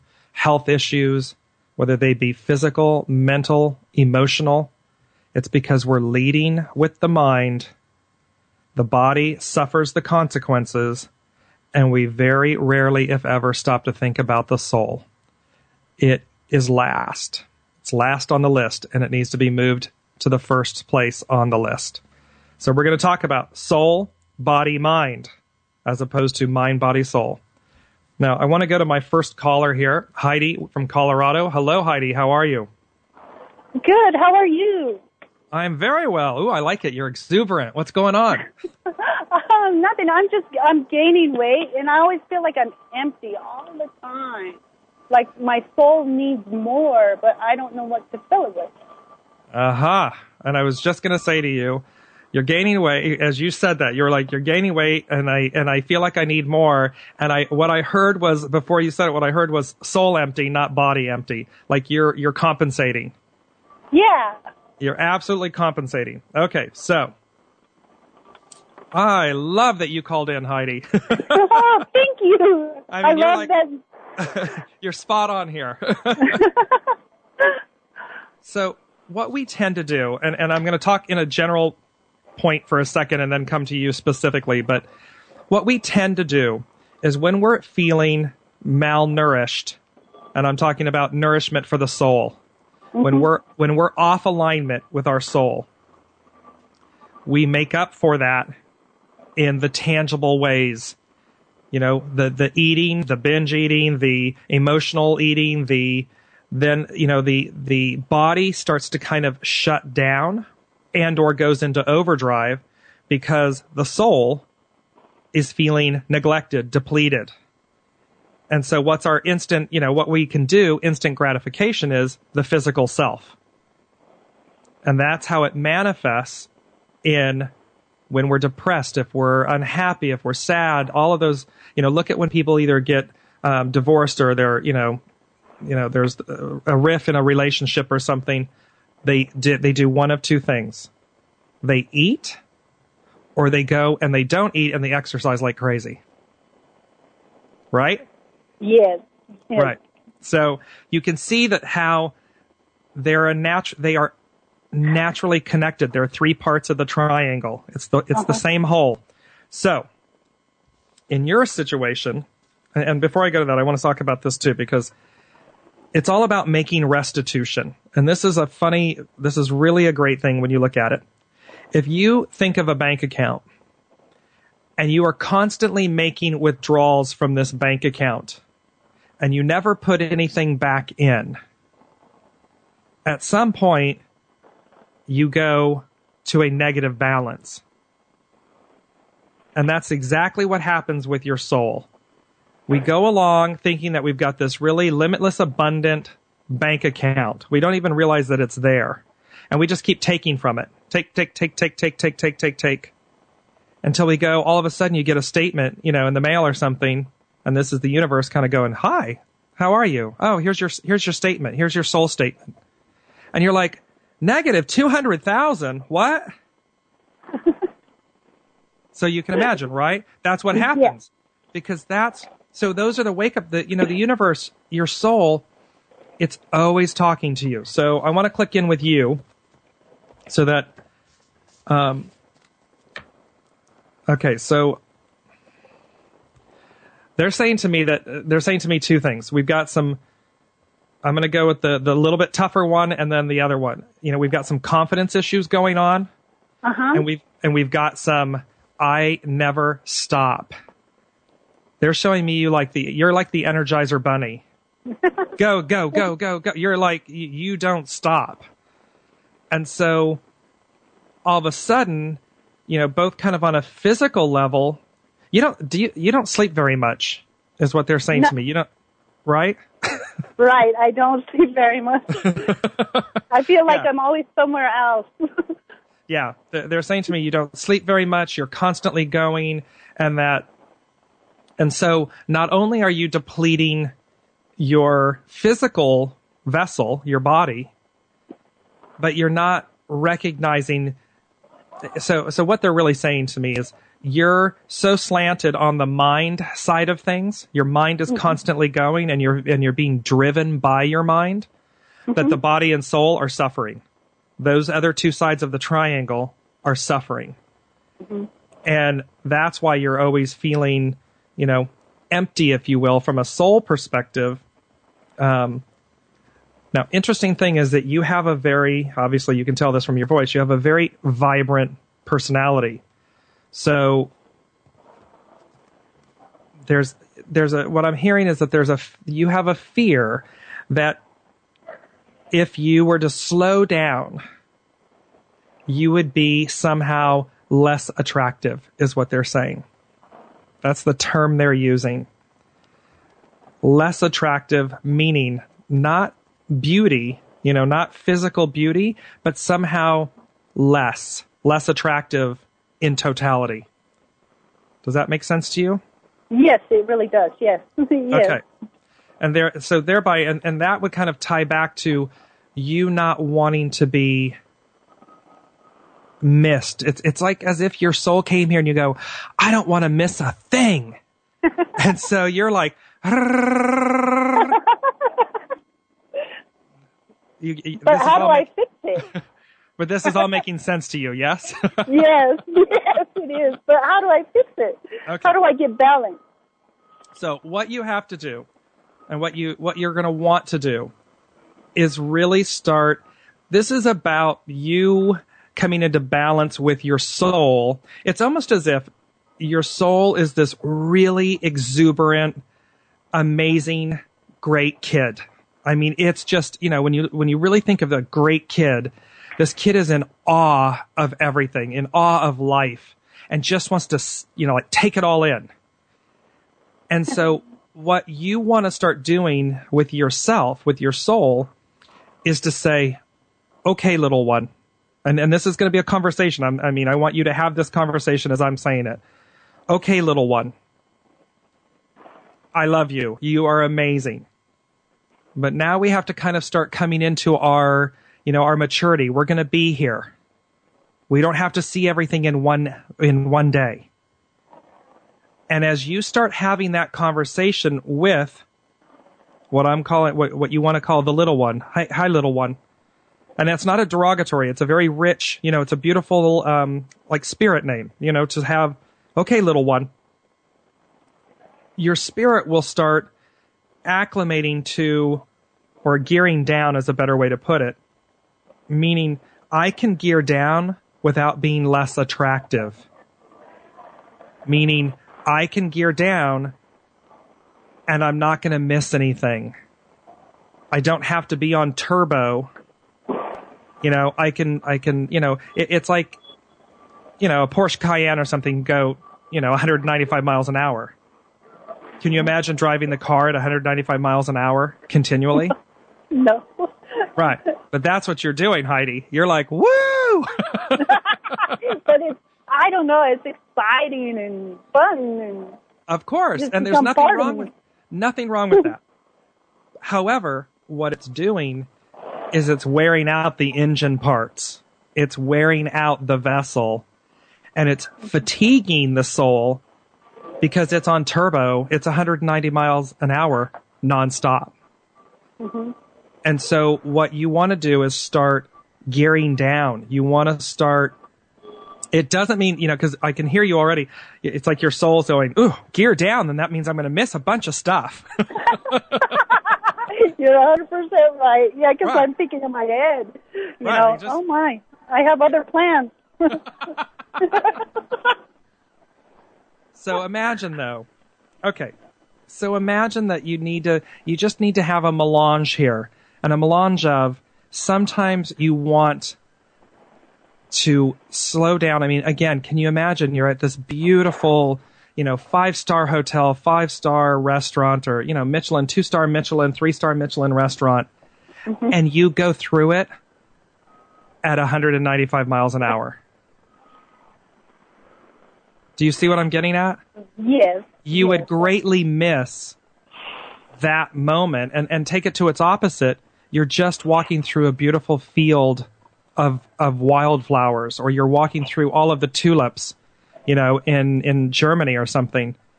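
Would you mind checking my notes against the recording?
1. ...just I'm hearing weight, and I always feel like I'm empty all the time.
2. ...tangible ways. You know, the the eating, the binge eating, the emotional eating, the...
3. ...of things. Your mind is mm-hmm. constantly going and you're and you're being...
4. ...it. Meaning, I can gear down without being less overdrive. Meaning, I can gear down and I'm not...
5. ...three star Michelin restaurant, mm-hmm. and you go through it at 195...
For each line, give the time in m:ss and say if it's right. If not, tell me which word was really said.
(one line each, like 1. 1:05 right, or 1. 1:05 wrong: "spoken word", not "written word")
1. 0:40 wrong: "gaining", not "hearing"
2. 1:39 right
3. 4:56 right
4. 7:47 wrong: "attractive", not "overdrive"
5. 9:29 right.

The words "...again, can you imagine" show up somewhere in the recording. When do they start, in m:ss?
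9:22.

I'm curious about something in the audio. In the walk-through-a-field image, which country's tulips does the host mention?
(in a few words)
Germany.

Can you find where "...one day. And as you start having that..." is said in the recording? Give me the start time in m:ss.
7:23.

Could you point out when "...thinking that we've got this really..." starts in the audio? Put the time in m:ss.
3:13.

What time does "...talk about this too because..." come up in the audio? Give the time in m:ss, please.
2:43.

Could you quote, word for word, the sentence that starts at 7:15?
But now we have to kind of start coming into our, you know, our maturity.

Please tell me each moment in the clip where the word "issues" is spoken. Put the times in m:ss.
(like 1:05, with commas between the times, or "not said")
0:00, 4:05.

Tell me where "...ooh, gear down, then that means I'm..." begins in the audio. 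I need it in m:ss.
8:55.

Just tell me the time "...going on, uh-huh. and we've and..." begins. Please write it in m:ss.
4:05.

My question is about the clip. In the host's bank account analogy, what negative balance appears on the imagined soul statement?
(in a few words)
-200,000.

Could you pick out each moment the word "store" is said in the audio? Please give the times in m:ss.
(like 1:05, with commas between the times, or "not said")
not said.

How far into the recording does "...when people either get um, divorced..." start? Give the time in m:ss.
2:12.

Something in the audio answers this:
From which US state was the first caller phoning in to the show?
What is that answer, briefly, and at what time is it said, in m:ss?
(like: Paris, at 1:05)
Colorado, at 0:30.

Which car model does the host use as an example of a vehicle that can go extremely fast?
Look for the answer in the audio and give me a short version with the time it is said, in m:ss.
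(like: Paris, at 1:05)
Porsche Cayenne, at 8:07.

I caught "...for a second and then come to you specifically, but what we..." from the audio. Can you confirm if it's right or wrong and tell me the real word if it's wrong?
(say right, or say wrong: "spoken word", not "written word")
right.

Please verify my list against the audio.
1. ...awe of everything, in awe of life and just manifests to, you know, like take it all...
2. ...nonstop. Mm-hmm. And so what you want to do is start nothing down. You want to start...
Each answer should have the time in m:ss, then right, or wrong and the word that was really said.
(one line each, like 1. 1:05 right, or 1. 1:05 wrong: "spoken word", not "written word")
1. 6:50 wrong: "wants", not "manifests"
2. 8:43 wrong: "gearing", not "nothing".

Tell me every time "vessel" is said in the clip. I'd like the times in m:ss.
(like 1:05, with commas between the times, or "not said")
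4:46, 8:36.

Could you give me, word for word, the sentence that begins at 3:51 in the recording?
Um, okay, so they're saying to me that they're saying to me two things.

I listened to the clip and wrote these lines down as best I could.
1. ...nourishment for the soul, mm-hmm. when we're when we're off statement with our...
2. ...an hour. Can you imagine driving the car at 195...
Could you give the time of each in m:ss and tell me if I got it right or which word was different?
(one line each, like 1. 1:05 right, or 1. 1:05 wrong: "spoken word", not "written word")
1. 1:31 wrong: "alignment", not "statement"
2. 8:10 right.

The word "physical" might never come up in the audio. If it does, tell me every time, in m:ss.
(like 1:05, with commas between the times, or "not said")
0:02, 2:02, 4:23, 4:45, 5:47.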